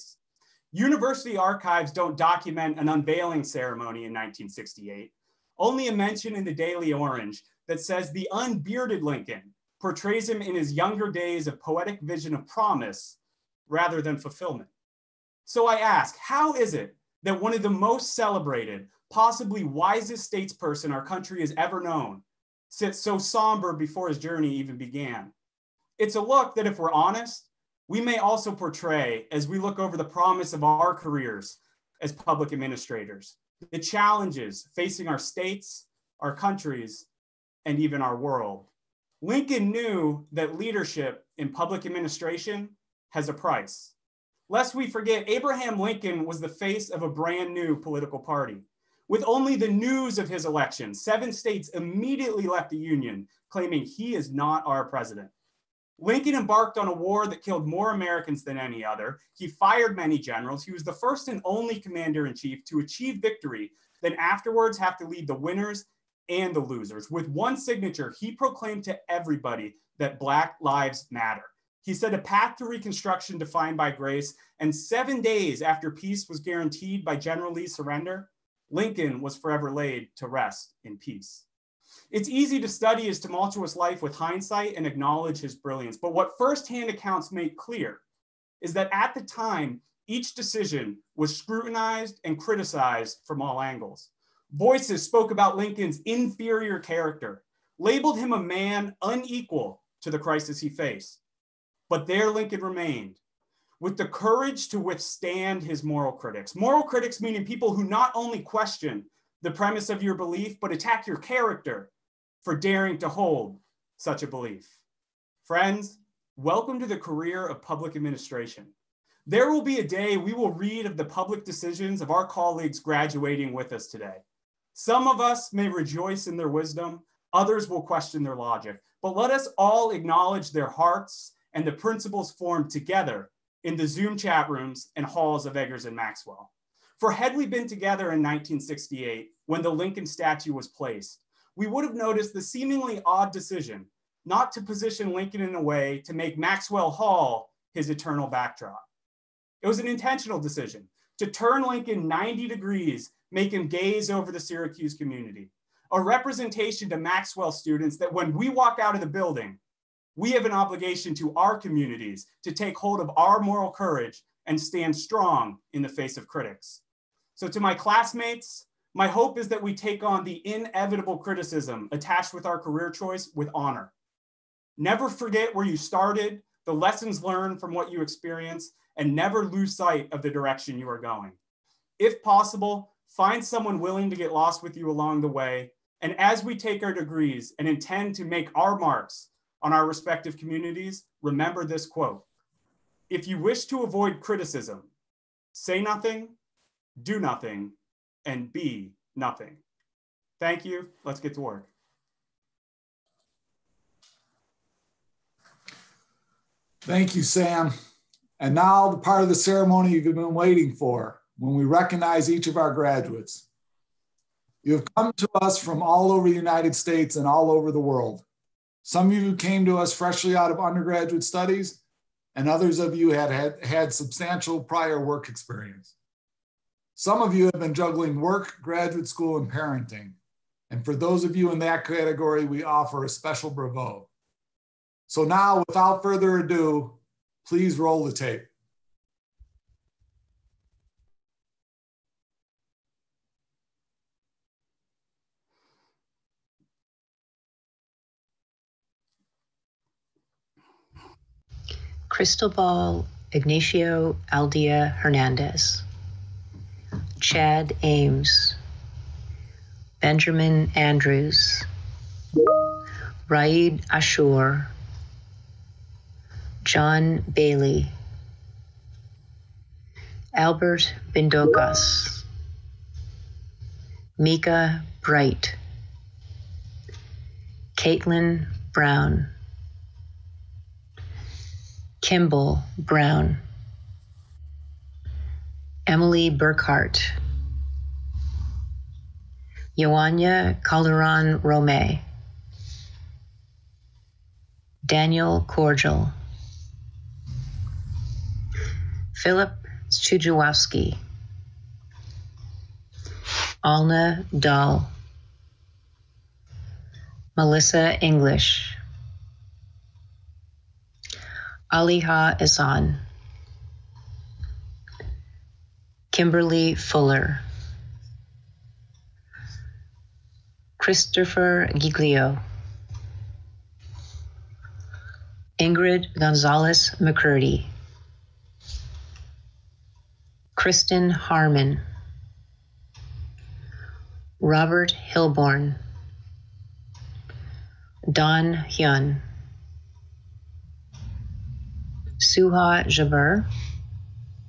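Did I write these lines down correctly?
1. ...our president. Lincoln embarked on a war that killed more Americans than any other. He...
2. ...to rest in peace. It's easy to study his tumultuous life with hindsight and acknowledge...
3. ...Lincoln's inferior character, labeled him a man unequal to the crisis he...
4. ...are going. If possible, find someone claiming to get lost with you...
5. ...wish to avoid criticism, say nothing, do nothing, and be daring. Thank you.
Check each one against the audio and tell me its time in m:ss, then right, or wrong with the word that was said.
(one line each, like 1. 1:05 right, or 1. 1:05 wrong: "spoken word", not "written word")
1. 0:54 right
2. 1:20 right
3. 1:35 right
4. 3:00 wrong: "willing", not "claiming"
5. 3:13 wrong: "nothing", not "daring".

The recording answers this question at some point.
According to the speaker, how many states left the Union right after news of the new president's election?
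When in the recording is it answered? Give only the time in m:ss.
0:50.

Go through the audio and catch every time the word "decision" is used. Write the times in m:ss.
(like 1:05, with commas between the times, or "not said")
1:30, 2:01, 2:23, 2:30.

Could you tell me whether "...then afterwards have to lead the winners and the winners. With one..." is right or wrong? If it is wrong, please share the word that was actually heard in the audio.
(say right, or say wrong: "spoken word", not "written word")
wrong: "losers", not "winners".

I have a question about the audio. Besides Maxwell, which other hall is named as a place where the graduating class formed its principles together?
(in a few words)
Eggers.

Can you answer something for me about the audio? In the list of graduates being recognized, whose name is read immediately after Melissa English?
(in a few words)
Aliha Isan.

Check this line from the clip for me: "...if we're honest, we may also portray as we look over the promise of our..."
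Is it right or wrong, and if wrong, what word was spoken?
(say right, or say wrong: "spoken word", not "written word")
right.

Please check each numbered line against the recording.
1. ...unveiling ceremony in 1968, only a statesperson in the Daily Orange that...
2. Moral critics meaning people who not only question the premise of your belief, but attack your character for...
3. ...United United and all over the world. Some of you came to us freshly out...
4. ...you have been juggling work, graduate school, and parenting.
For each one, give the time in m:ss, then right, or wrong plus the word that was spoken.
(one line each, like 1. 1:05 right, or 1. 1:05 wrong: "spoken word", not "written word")
1. 0:02 wrong: "mention", not "statesperson"
2. 1:46 right
3. 3:36 wrong: "States", not "United"
4. 3:47 right.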